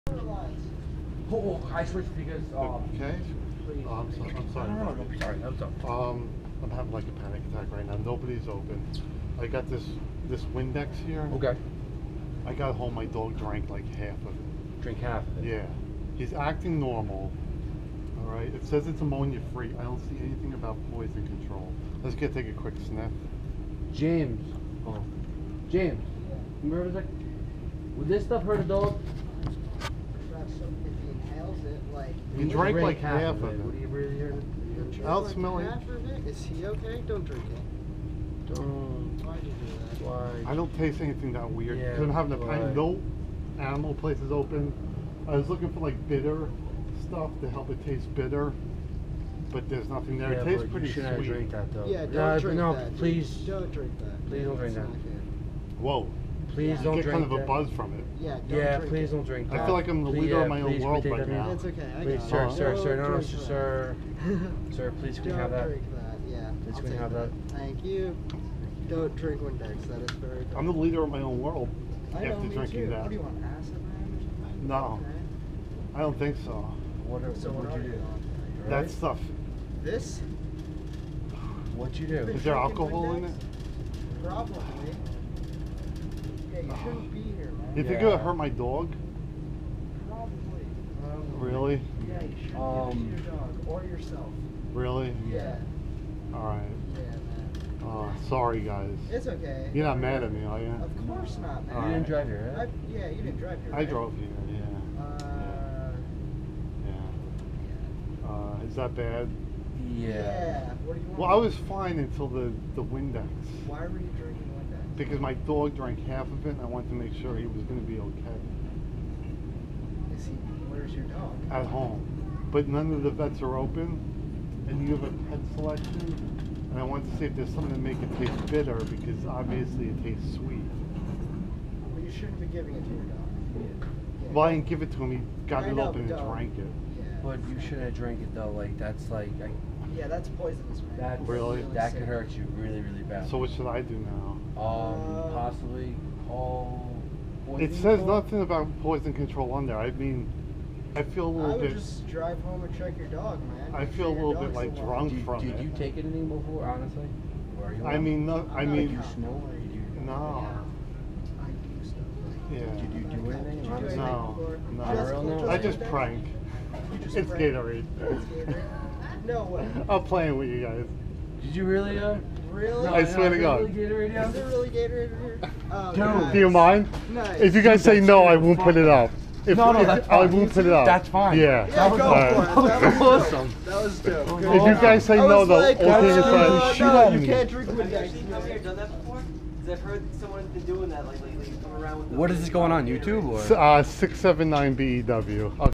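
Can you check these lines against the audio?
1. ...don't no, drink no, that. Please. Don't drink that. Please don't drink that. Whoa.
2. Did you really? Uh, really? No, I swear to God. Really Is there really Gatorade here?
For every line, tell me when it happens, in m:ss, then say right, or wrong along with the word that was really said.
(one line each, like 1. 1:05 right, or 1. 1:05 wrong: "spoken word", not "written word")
1. 0:52 right
2. 2:51 right.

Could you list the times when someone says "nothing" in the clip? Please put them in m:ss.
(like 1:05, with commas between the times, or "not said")
0:49, 2:28.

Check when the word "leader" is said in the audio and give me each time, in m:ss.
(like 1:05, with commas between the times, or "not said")
1:00, 1:10.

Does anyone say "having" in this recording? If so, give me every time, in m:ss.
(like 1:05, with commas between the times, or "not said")
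0:06, 0:42.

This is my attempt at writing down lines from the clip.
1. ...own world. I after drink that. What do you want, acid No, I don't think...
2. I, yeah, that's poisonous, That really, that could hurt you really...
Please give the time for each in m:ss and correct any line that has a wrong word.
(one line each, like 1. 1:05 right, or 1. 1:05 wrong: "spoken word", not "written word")
1. 1:11 right
2. 2:19 right.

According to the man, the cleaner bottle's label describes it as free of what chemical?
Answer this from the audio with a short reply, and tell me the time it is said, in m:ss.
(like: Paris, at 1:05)
ammonia, at 0:19.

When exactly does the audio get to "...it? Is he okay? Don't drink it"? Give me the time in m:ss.
0:36.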